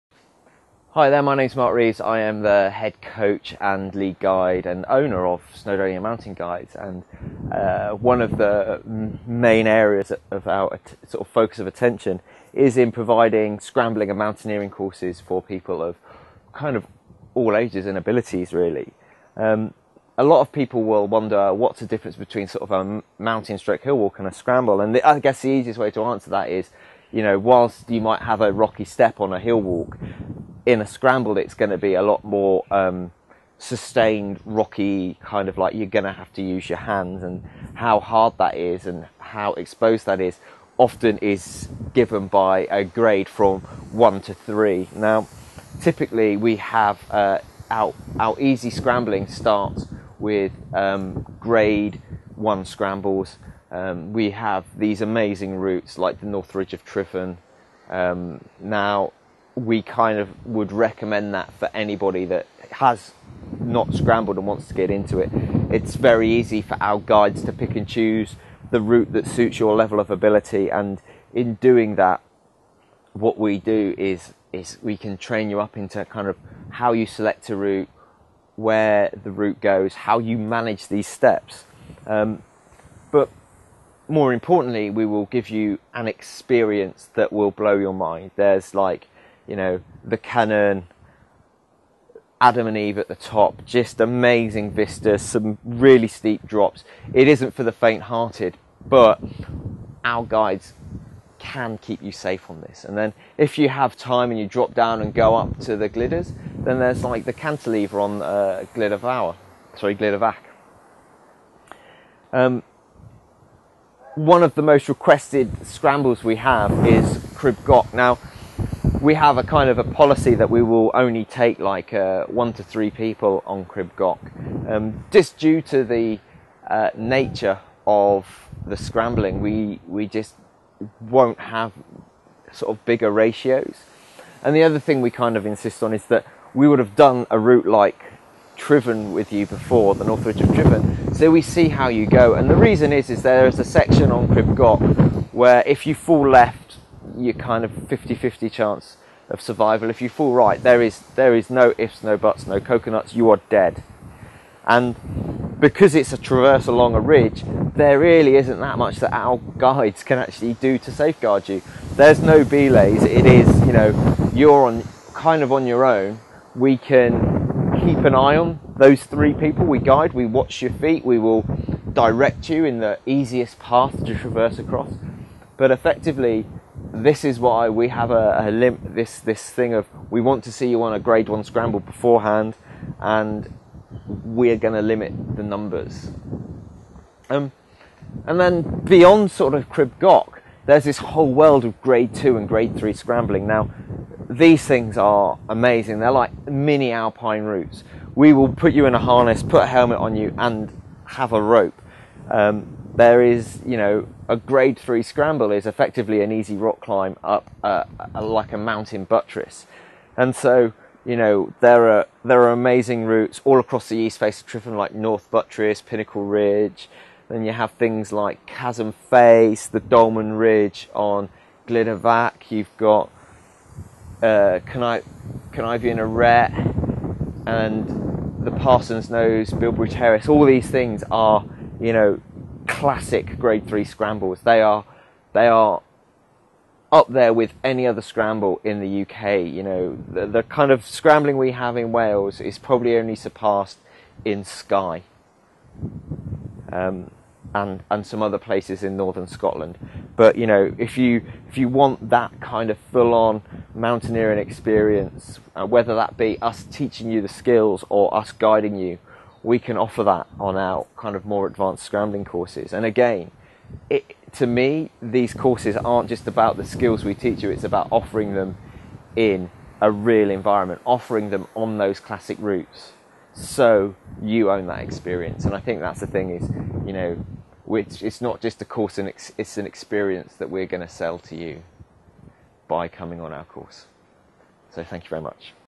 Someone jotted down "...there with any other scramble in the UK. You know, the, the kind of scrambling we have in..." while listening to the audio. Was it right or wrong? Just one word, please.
right.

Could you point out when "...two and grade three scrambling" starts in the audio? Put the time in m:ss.
3:12.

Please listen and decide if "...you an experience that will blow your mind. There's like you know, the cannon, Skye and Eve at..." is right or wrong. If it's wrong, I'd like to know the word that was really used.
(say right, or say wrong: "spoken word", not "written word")
wrong: "Adam", not "Skye".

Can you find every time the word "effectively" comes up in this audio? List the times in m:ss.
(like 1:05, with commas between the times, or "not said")
2:55, 3:25.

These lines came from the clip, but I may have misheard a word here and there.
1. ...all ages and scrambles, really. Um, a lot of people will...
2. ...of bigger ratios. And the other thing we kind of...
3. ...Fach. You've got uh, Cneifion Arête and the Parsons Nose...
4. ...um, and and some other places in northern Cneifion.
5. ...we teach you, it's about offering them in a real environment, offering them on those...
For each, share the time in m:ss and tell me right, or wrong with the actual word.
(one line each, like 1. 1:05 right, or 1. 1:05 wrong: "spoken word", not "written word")
1. 0:17 wrong: "abilities", not "scrambles"
2. 2:12 right
3. 3:42 right
4. 4:06 wrong: "Scotland", not "Cneifion"
5. 4:27 right.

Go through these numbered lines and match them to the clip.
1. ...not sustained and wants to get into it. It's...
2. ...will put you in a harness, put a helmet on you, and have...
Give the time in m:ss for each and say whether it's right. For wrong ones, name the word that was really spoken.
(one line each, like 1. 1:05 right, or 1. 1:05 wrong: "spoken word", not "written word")
1. 1:03 wrong: "scrambled", not "sustained"
2. 3:18 right.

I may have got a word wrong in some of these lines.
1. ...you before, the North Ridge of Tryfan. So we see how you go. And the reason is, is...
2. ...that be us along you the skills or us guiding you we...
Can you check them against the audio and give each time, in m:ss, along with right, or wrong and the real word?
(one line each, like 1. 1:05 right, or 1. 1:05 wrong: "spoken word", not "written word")
1. 2:19 right
2. 4:15 wrong: "teaching", not "along".